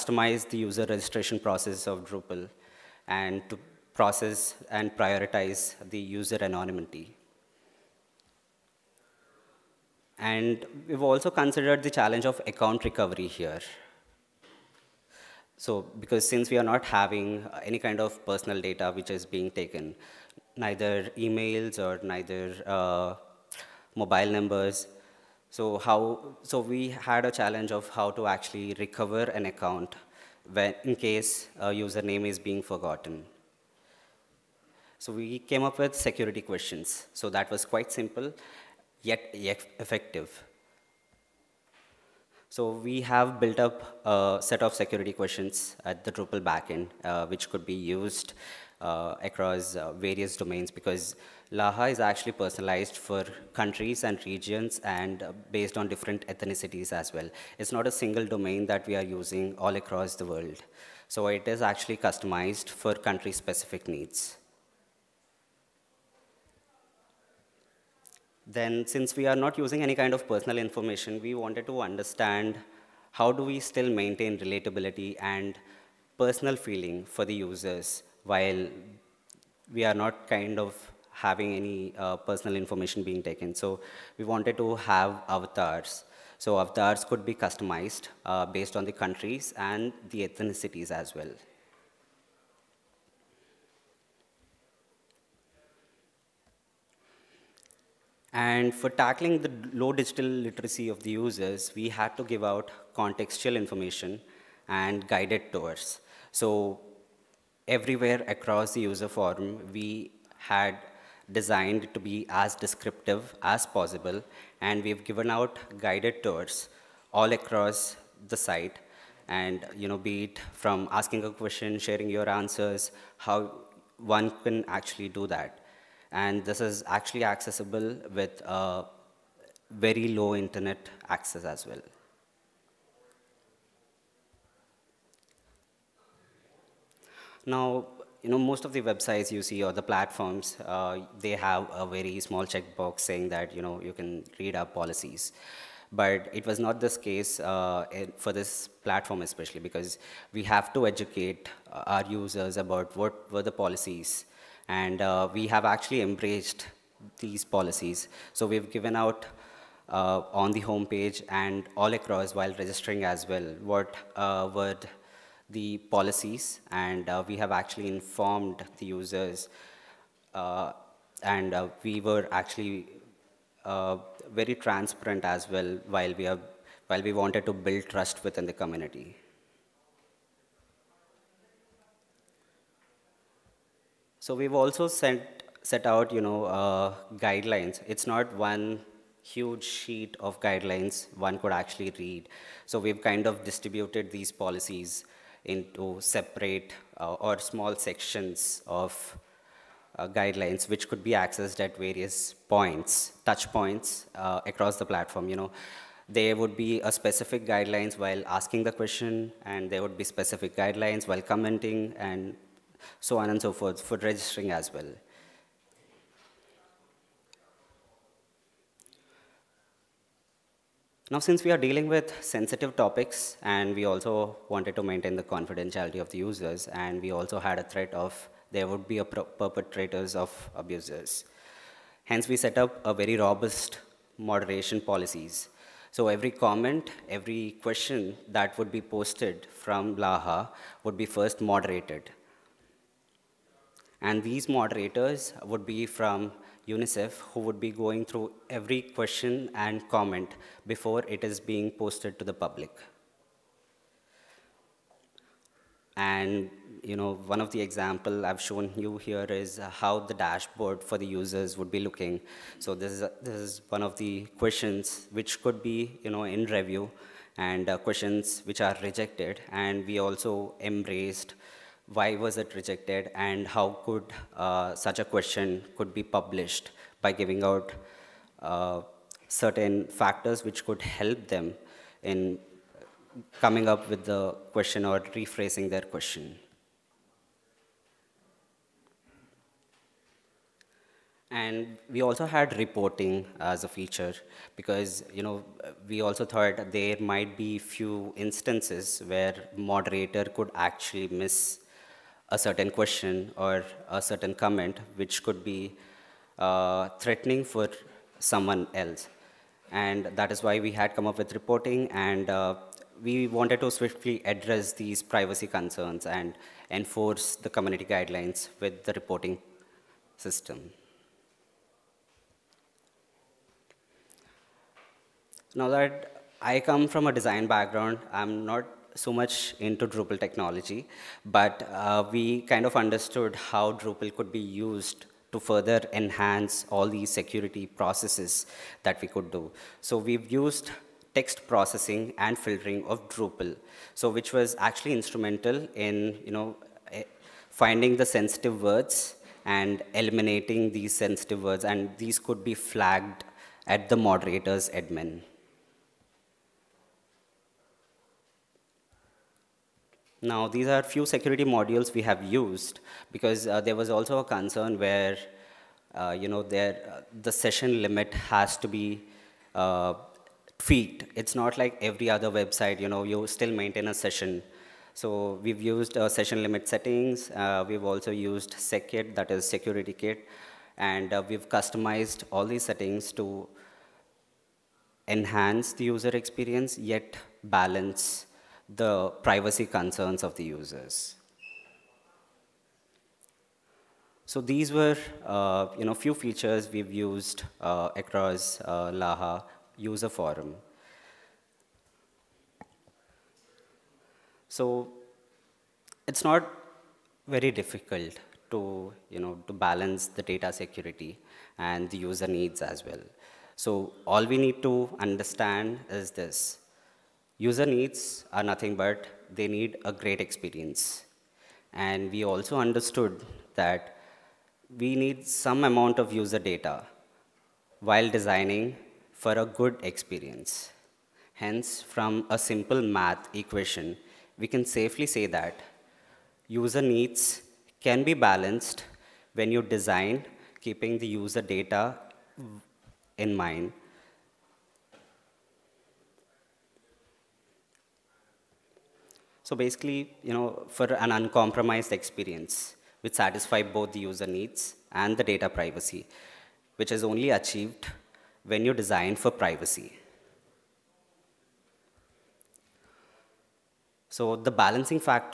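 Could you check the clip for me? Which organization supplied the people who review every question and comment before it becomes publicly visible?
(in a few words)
UNICEF.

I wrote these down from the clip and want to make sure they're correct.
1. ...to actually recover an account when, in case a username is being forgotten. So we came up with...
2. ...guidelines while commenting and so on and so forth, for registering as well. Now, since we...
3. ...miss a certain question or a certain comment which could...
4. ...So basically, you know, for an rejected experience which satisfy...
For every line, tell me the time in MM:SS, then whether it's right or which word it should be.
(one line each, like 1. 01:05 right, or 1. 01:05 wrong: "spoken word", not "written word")
1. 00:28 right
2. 03:30 right
3. 05:01 right
4. 07:29 wrong: "uncompromised", not "rejected".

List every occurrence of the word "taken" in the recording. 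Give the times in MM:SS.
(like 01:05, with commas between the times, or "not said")
00:19, 01:23.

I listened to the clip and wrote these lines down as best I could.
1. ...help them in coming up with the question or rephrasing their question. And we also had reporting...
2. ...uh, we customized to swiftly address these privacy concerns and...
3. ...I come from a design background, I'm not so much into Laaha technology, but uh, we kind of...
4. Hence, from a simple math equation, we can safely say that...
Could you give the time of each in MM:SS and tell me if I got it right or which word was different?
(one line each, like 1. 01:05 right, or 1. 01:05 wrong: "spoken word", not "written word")
1. 04:40 right
2. 05:12 wrong: "wanted", not "customized"
3. 05:26 wrong: "Drupal", not "Laaha"
4. 07:11 right.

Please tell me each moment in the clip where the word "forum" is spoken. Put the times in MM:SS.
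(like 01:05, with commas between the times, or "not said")
01:49, 06:40.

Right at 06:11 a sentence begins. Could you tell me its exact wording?
It's not like every other website, you know, you still maintain a session.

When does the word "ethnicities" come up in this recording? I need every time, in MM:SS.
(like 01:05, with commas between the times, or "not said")
00:56, 01:30.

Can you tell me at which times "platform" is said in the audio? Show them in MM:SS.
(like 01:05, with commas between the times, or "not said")
02:19, 02:28, 03:24.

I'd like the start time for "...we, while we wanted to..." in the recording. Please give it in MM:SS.
02:56.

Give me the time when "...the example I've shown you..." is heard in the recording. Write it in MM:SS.
04:17.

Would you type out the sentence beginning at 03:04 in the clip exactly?
So we've also sent, set out, you know, uh, guidelines.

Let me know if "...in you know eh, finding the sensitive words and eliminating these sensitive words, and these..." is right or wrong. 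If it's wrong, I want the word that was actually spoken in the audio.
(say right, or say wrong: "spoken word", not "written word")
right.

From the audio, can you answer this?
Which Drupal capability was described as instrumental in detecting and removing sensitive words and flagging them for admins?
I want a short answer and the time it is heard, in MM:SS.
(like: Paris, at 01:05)
Text processing and filtering, at 05:41.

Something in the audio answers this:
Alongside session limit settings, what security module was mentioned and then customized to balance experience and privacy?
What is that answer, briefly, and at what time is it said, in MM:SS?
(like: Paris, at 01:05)
SecKit, at 06:18.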